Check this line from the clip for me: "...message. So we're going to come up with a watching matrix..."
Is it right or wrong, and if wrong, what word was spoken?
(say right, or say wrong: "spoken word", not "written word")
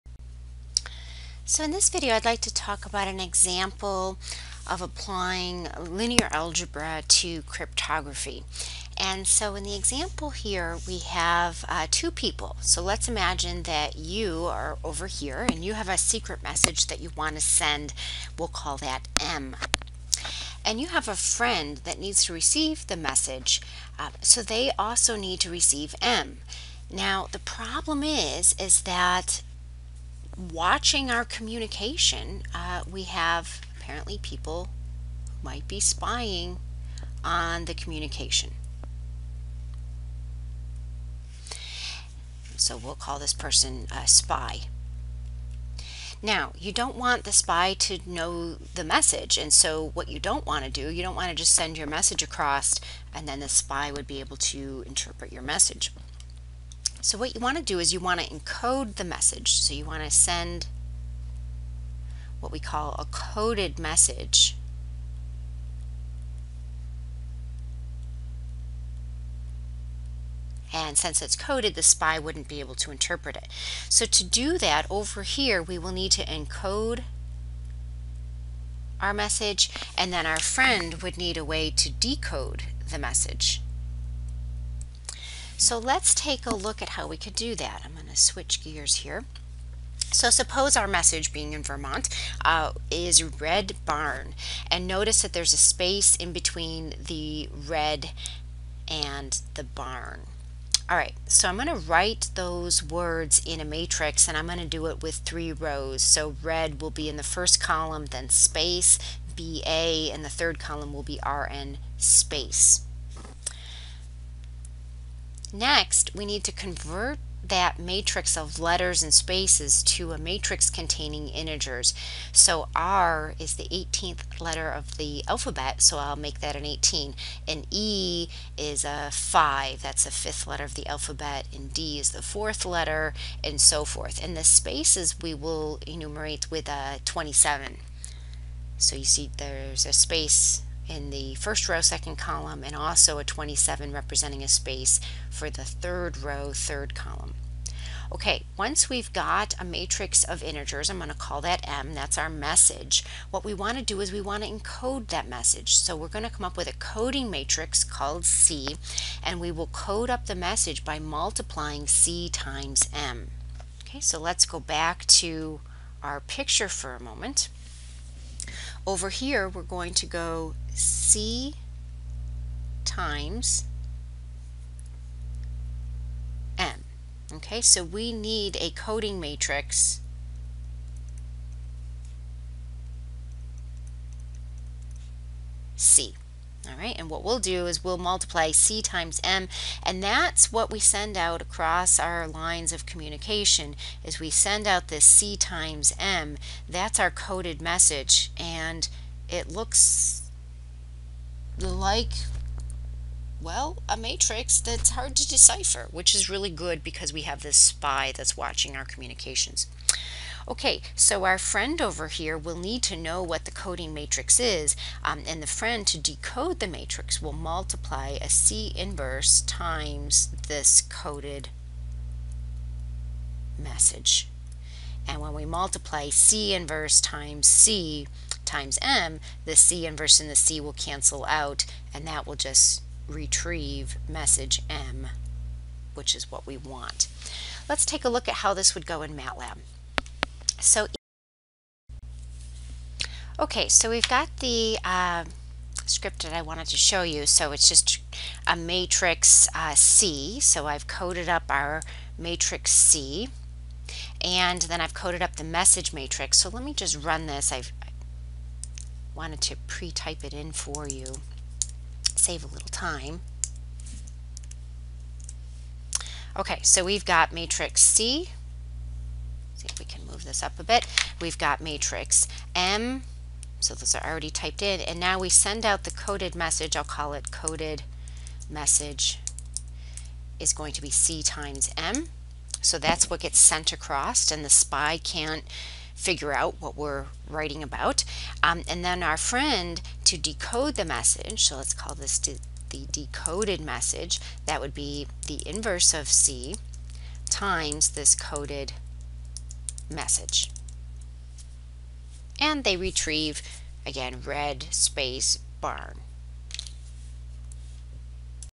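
wrong: "coding", not "watching".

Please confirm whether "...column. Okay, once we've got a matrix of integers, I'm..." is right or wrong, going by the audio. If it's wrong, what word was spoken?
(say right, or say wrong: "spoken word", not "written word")
right.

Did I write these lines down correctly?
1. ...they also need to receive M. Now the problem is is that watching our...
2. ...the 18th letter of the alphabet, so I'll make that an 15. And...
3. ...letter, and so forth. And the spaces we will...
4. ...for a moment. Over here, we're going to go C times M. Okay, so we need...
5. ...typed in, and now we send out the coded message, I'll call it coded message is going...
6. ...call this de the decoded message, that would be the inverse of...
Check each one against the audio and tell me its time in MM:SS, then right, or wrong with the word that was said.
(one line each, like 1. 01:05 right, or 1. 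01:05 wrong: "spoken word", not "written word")
1. 00:24 right
2. 02:03 wrong: "18", not "15"
3. 02:12 right
4. 02:46 right
5. 04:34 right
6. 04:51 right.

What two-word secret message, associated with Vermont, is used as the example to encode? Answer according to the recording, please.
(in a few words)
red barn.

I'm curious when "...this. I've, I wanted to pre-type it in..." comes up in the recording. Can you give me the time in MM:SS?
04:17.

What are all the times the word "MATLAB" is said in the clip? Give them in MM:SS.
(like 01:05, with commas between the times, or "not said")
03:59.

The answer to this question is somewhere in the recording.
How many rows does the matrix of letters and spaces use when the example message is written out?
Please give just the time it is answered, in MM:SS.
01:45.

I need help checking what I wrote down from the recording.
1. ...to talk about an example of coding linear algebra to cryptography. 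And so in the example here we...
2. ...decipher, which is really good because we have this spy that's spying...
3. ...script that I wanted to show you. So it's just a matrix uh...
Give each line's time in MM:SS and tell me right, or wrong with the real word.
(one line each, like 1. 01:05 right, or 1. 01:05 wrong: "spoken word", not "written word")
1. 00:02 wrong: "applying", not "coding"
2. 03:25 wrong: "watching", not "spying"
3. 04:05 right.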